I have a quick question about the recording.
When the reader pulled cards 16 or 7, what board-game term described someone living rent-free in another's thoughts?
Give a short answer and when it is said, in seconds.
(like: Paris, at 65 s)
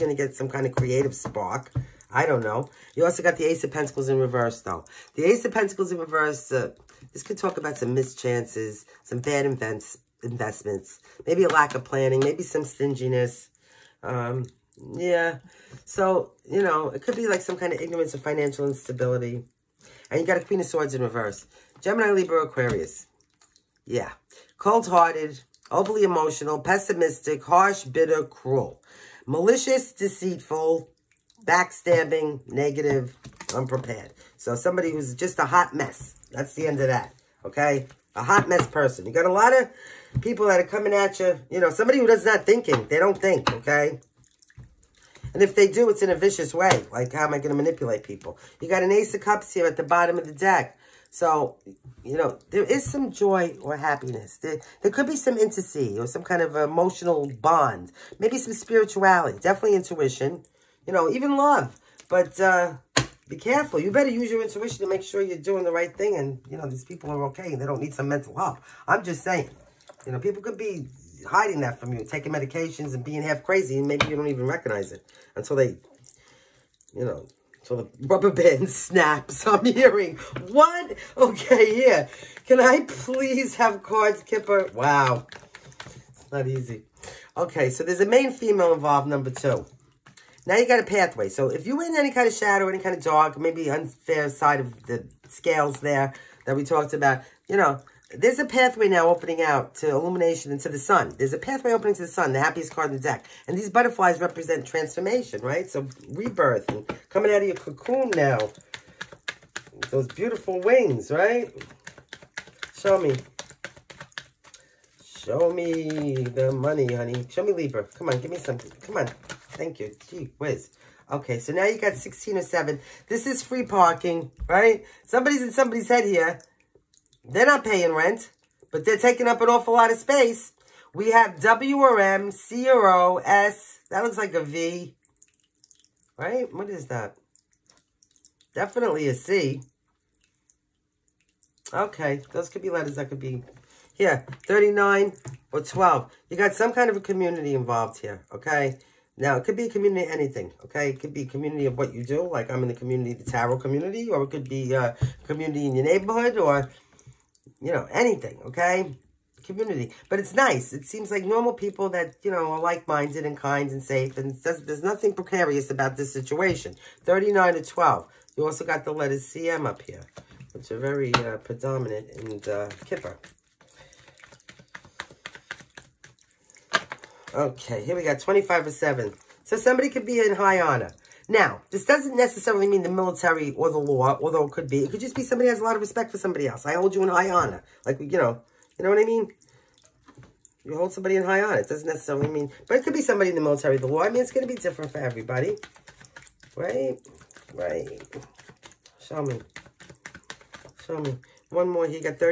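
Free parking, at 123 s.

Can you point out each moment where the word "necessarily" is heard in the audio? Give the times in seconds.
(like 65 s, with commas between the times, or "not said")
182 s, 191 s.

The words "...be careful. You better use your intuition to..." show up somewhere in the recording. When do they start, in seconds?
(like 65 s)
63 s.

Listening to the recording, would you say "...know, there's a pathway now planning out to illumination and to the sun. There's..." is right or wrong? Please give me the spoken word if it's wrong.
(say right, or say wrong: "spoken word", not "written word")
wrong: "opening", not "planning".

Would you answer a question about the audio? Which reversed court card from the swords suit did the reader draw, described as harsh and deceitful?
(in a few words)
Queen of Swords.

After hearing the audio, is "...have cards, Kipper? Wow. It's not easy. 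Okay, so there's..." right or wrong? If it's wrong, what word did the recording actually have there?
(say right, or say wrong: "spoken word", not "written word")
right.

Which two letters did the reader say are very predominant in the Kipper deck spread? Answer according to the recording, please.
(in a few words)
CM.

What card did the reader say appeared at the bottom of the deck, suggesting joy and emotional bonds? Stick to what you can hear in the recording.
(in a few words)
Ace of Cups.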